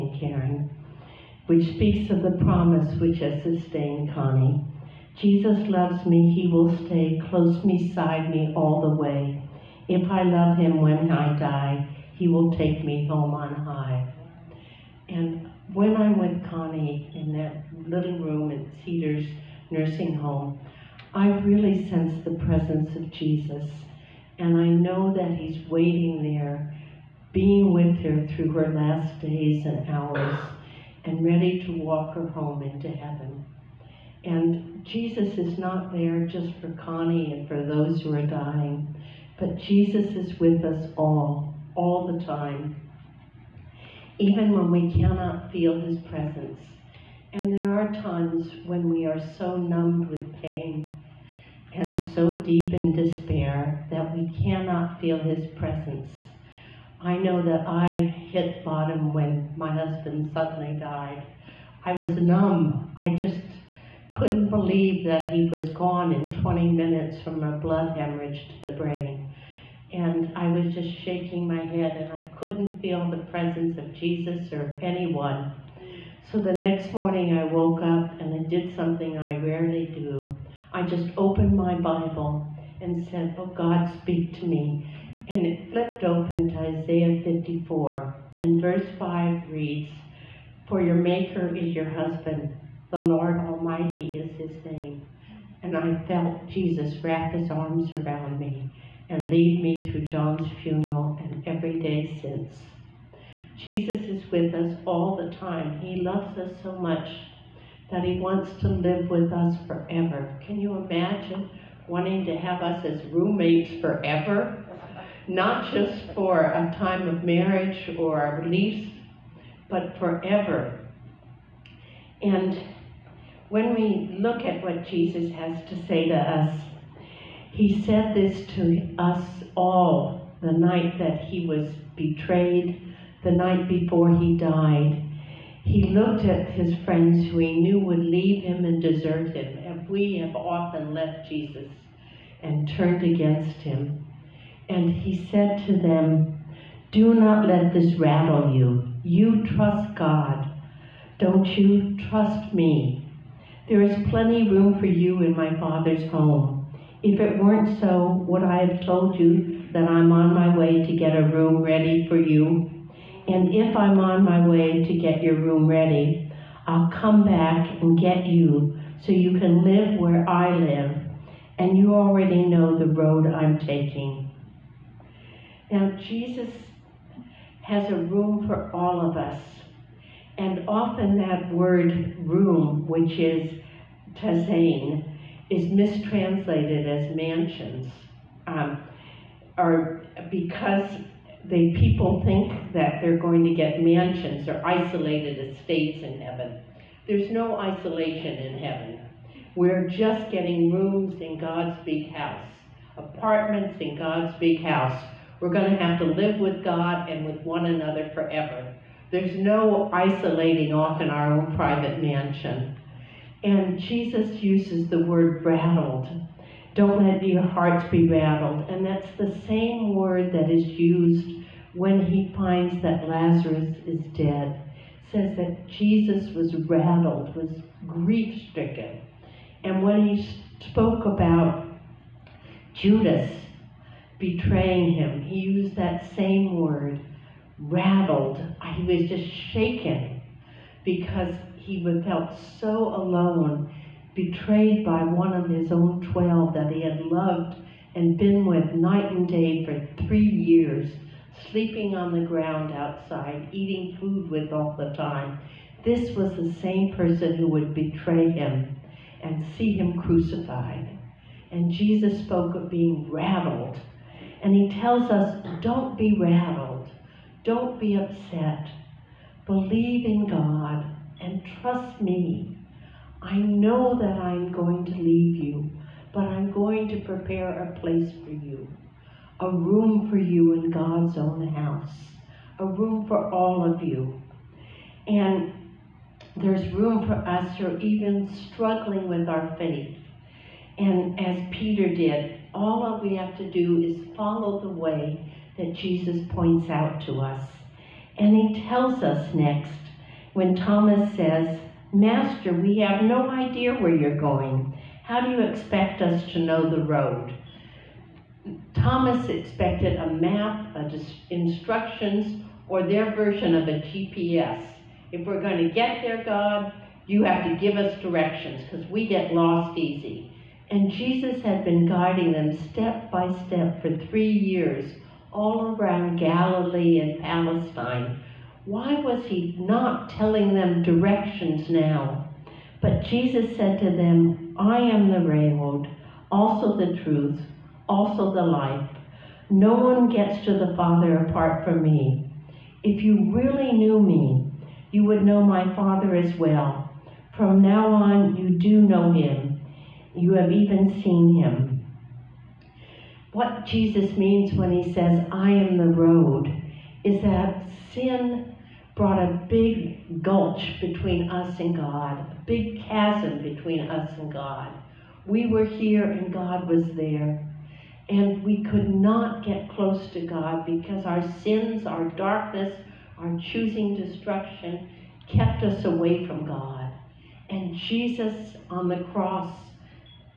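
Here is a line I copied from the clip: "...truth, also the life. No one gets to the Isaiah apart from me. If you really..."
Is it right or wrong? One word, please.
wrong.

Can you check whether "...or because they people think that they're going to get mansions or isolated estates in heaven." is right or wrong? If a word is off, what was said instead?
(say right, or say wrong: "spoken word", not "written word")
right.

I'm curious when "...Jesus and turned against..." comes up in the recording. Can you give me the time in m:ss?
2:21.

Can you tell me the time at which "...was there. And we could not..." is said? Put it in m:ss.
6:06.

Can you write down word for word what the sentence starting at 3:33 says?
And Jesus uses the word rattled.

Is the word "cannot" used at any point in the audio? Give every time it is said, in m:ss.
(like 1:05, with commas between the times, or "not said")
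0:45, 0:54.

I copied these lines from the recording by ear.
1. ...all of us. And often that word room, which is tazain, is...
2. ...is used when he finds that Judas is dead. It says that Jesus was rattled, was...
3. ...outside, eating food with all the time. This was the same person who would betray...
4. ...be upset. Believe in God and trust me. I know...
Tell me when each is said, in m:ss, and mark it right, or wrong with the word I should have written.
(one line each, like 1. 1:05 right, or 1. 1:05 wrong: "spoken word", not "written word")
1. 2:58 right
2. 3:40 wrong: "Lazarus", not "Judas"
3. 4:12 right
4. 4:27 right.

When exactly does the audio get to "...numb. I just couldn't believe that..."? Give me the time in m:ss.
1:02.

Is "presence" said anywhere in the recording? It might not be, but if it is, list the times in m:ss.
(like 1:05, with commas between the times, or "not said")
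0:22, 0:46, 0:55, 1:13.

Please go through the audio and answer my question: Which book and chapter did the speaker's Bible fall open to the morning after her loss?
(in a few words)
Isaiah 54.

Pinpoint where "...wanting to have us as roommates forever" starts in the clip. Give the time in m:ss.
1:51.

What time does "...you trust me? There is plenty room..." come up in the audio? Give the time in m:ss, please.
2:31.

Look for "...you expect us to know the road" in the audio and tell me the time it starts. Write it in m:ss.
5:05.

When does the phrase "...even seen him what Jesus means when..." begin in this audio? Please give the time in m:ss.
5:50.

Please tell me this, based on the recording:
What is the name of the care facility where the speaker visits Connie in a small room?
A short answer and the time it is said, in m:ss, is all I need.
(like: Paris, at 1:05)
Cedars Nursing Home, at 0:18.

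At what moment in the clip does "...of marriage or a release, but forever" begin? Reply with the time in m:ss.
1:57.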